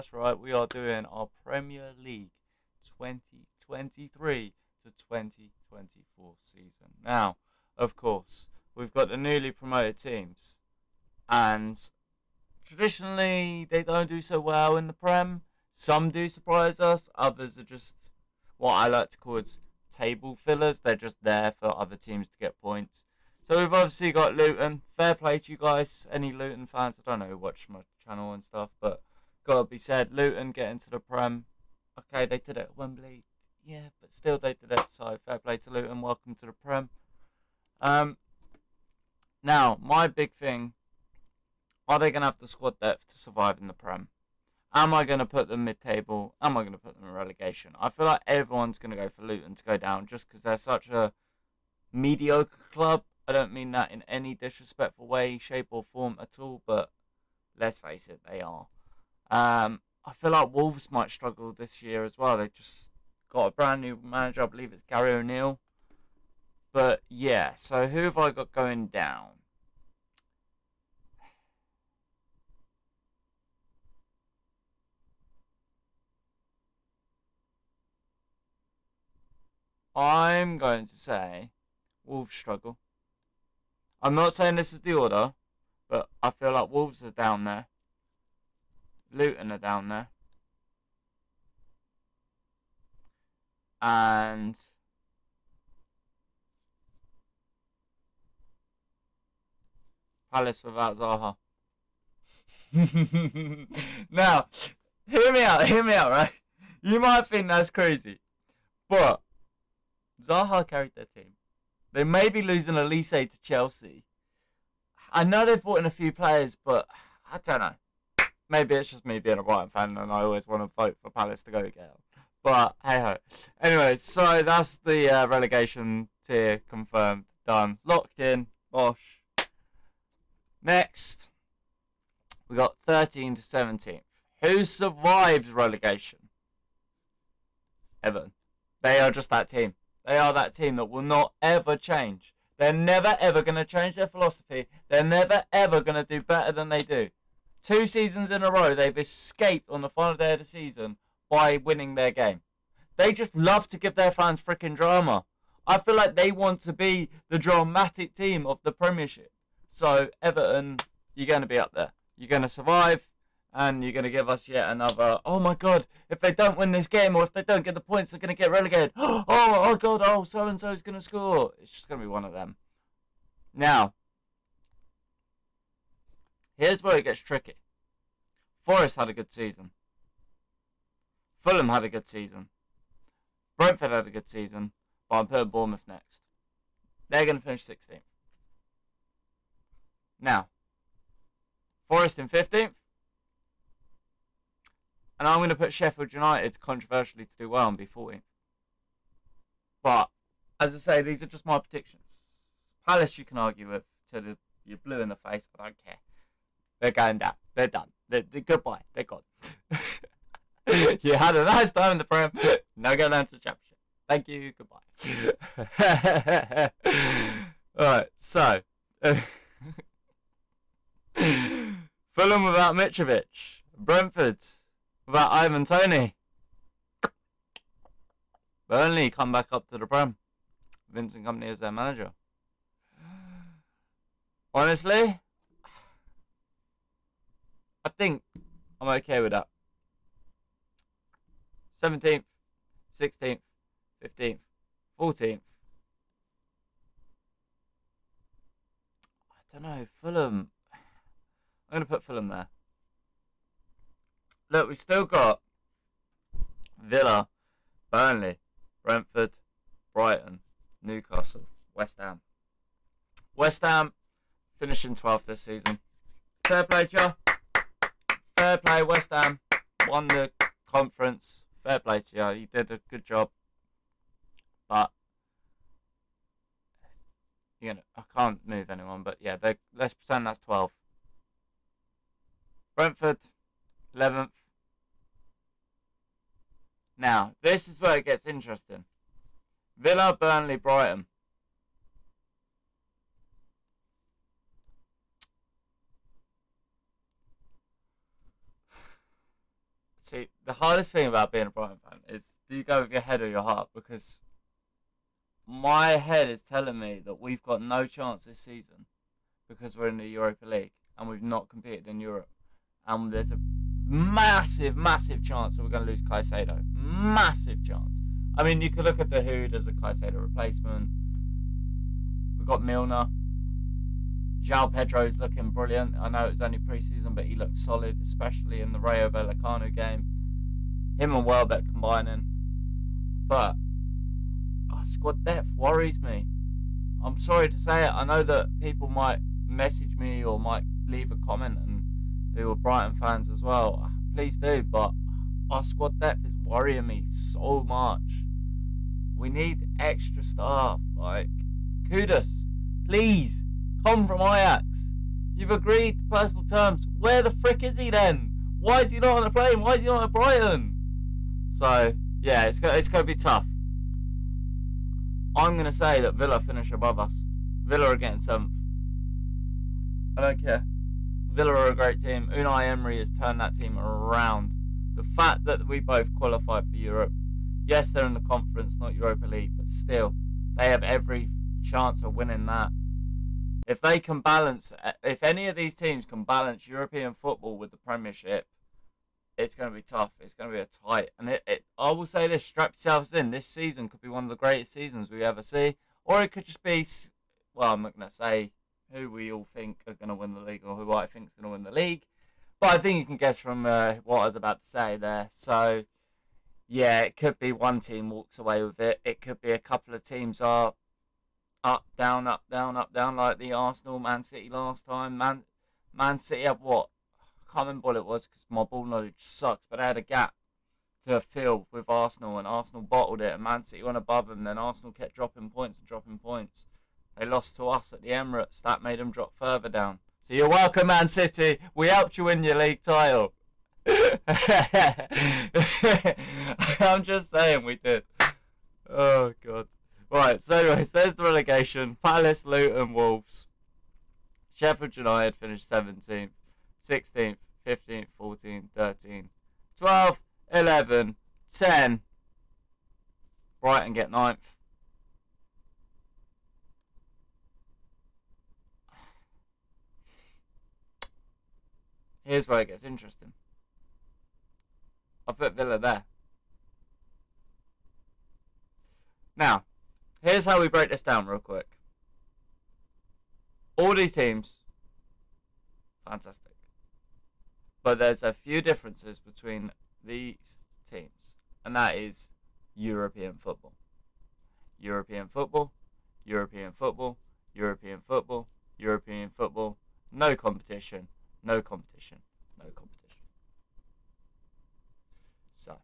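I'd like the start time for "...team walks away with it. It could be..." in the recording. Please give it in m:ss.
6:47.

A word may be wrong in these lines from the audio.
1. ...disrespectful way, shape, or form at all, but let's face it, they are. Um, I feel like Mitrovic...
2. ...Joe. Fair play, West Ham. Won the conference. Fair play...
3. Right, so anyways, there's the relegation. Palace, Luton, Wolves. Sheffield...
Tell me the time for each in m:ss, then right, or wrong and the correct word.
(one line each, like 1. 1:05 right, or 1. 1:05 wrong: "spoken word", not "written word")
1. 0:54 wrong: "Wolves", not "Mitrovic"
2. 4:26 right
3. 7:20 right.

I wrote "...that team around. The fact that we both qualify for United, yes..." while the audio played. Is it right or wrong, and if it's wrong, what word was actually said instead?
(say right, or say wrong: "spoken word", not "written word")
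wrong: "Europe", not "United".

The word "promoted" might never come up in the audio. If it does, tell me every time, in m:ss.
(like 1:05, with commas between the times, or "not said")
0:09.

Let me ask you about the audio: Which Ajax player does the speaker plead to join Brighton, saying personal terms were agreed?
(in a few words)
Kudus.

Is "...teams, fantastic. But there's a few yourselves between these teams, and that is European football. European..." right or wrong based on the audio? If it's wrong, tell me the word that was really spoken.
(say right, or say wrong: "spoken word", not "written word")
wrong: "differences", not "yourselves".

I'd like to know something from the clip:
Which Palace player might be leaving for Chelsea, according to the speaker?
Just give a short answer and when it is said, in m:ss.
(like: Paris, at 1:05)
Olise, at 1:52.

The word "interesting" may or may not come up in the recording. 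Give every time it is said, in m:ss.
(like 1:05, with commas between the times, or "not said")
4:48, 7:42.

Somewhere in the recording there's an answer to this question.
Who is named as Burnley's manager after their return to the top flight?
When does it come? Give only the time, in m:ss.
3:50.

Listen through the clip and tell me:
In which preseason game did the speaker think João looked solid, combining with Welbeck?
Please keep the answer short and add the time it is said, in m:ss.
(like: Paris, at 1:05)
Rayo Vallecano, at 5:28.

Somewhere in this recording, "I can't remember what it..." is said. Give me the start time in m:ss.
6:57.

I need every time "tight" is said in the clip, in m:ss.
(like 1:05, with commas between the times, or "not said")
6:30.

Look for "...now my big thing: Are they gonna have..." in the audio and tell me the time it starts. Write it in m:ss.
0:39.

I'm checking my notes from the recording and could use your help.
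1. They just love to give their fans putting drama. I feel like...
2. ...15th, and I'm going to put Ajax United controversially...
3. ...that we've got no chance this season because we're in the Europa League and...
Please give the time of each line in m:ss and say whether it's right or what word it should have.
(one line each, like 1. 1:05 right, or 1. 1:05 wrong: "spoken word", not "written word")
1. 2:32 wrong: "freaking", not "putting"
2. 3:12 wrong: "Sheffield", not "Ajax"
3. 5:07 right.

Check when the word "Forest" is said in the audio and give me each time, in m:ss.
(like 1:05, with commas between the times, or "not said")
2:58, 3:11.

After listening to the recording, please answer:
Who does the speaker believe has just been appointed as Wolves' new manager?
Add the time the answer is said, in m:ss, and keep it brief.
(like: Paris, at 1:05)
Gary O'Neil, at 1:04.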